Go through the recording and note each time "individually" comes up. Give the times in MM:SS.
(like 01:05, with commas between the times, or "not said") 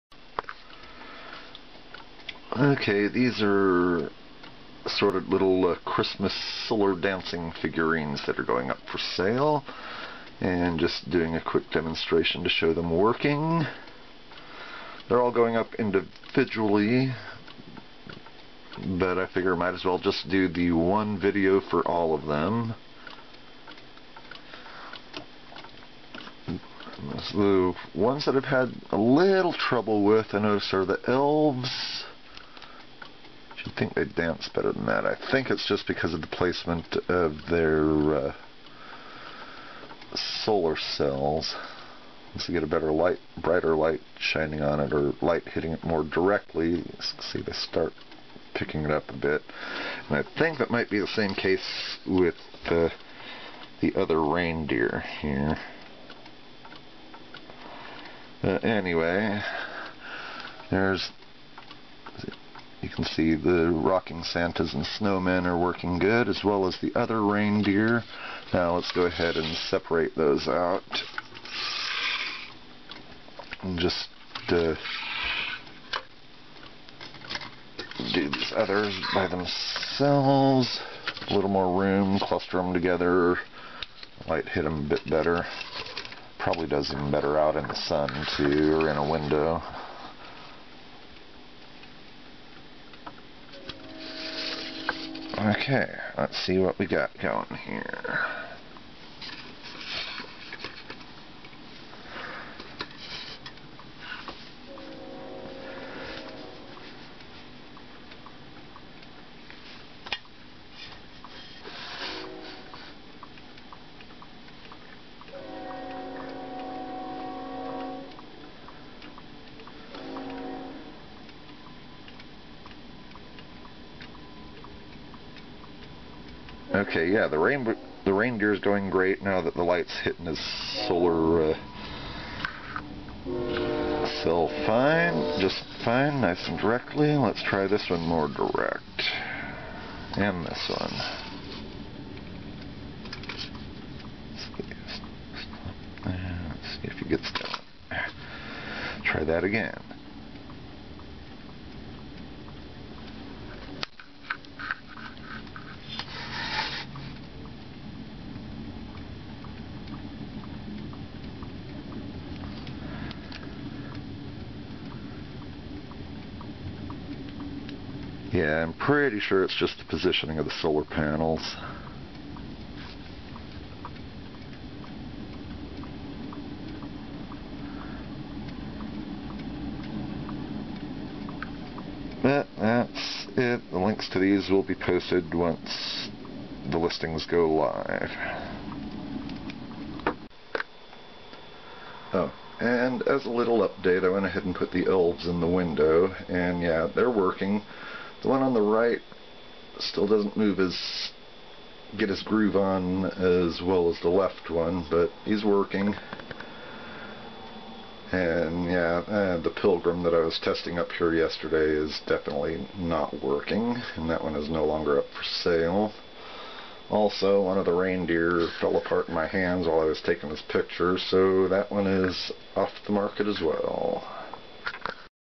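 00:15.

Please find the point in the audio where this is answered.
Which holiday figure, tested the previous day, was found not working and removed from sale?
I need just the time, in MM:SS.
03:29.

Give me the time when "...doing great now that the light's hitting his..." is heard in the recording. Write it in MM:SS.
02:08.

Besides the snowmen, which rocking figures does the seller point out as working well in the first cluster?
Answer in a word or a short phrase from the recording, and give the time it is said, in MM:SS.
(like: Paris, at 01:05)
Santas, at 01:04.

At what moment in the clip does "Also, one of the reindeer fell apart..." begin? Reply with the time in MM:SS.
03:36.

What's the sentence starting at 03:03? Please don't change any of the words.
The links to these will be posted once the listings go live.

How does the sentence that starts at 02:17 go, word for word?
Let's try this one more direct.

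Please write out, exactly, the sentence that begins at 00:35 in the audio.
I think it's just because of the placement of their uh, solar cells.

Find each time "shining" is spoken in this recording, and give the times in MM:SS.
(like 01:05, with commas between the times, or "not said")
00:44.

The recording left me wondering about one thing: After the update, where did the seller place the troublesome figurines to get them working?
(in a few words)
In the window.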